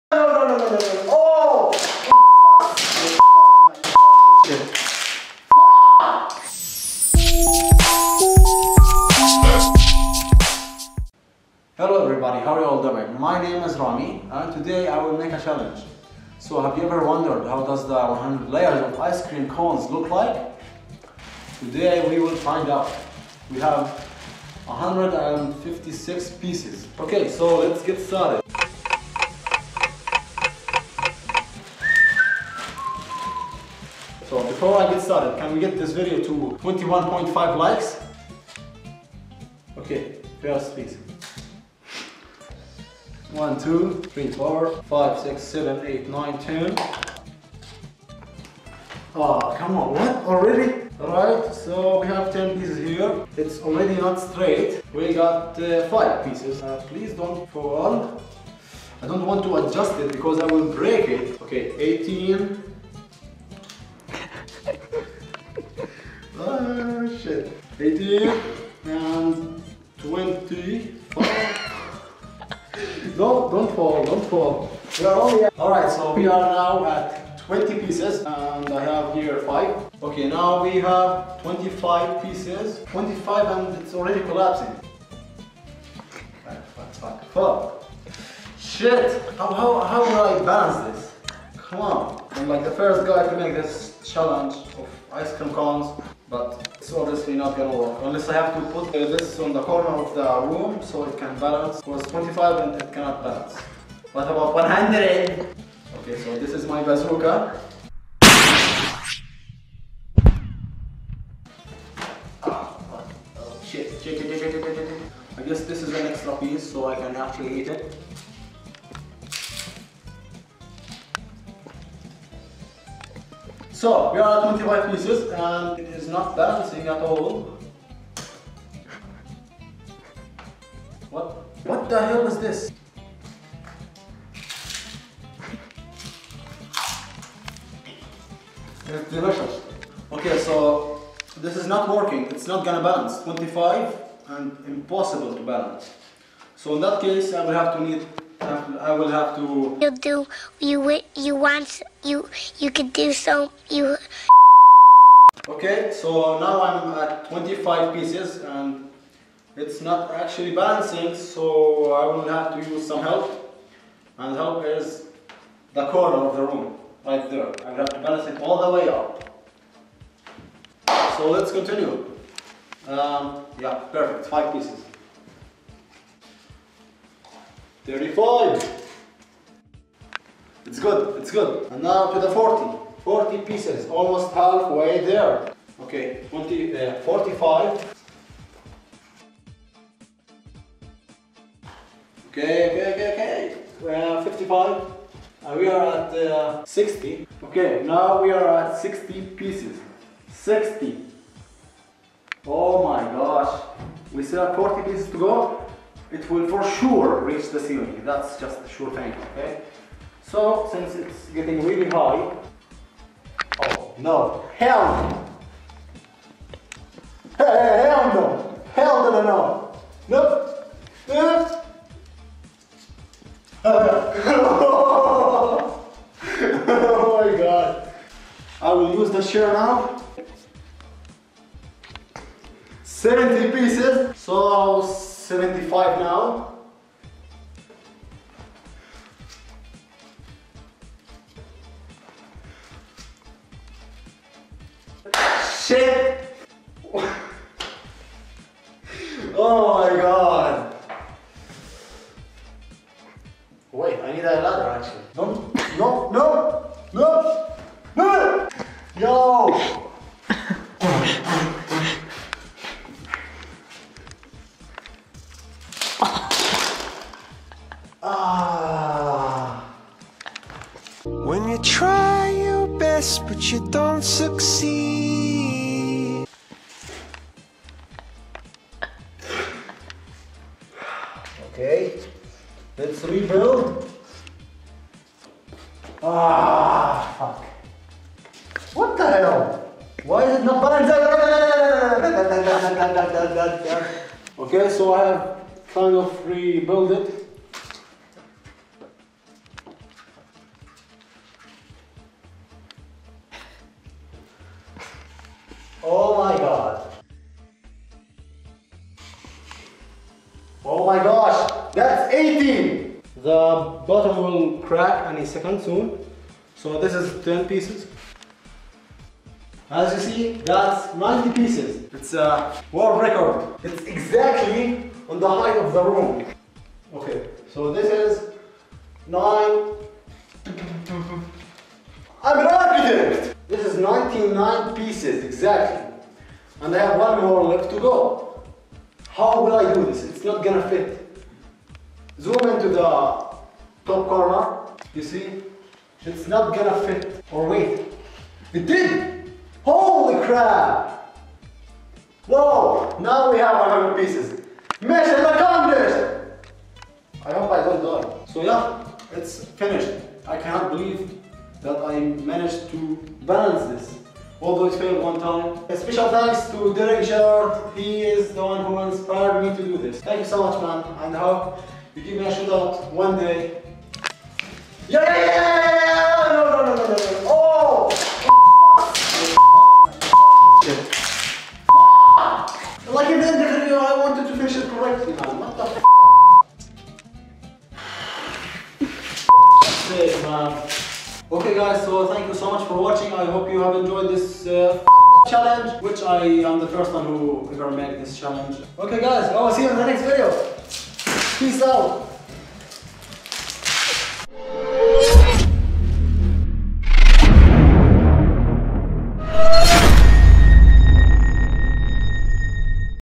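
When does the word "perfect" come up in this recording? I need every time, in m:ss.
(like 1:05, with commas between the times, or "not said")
2:53.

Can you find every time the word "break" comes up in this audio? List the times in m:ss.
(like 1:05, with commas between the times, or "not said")
1:00.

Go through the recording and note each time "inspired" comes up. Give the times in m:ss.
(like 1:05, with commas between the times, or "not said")
6:08.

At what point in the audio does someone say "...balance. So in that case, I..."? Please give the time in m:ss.
2:25.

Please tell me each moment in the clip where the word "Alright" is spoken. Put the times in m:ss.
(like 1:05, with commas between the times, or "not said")
0:50, 1:15.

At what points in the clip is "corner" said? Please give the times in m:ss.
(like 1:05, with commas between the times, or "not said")
1:39, 2:45, 5:43.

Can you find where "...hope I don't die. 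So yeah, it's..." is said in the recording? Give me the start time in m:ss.
5:57.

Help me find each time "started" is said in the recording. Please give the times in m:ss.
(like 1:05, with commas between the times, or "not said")
0:27, 0:35.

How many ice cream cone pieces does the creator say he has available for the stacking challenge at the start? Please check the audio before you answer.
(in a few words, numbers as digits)
156.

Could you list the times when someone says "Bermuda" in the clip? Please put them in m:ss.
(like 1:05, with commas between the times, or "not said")
not said.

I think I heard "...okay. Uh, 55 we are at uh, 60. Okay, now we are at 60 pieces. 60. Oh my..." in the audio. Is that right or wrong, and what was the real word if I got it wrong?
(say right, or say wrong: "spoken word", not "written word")
right.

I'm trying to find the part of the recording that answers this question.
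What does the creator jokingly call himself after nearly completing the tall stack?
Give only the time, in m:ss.
5:32.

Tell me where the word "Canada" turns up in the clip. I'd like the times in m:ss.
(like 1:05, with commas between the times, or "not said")
not said.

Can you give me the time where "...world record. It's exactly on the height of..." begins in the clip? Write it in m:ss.
5:22.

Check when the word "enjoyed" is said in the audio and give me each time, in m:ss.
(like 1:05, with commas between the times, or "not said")
6:33.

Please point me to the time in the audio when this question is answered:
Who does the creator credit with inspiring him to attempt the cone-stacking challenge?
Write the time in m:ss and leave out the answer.
6:06.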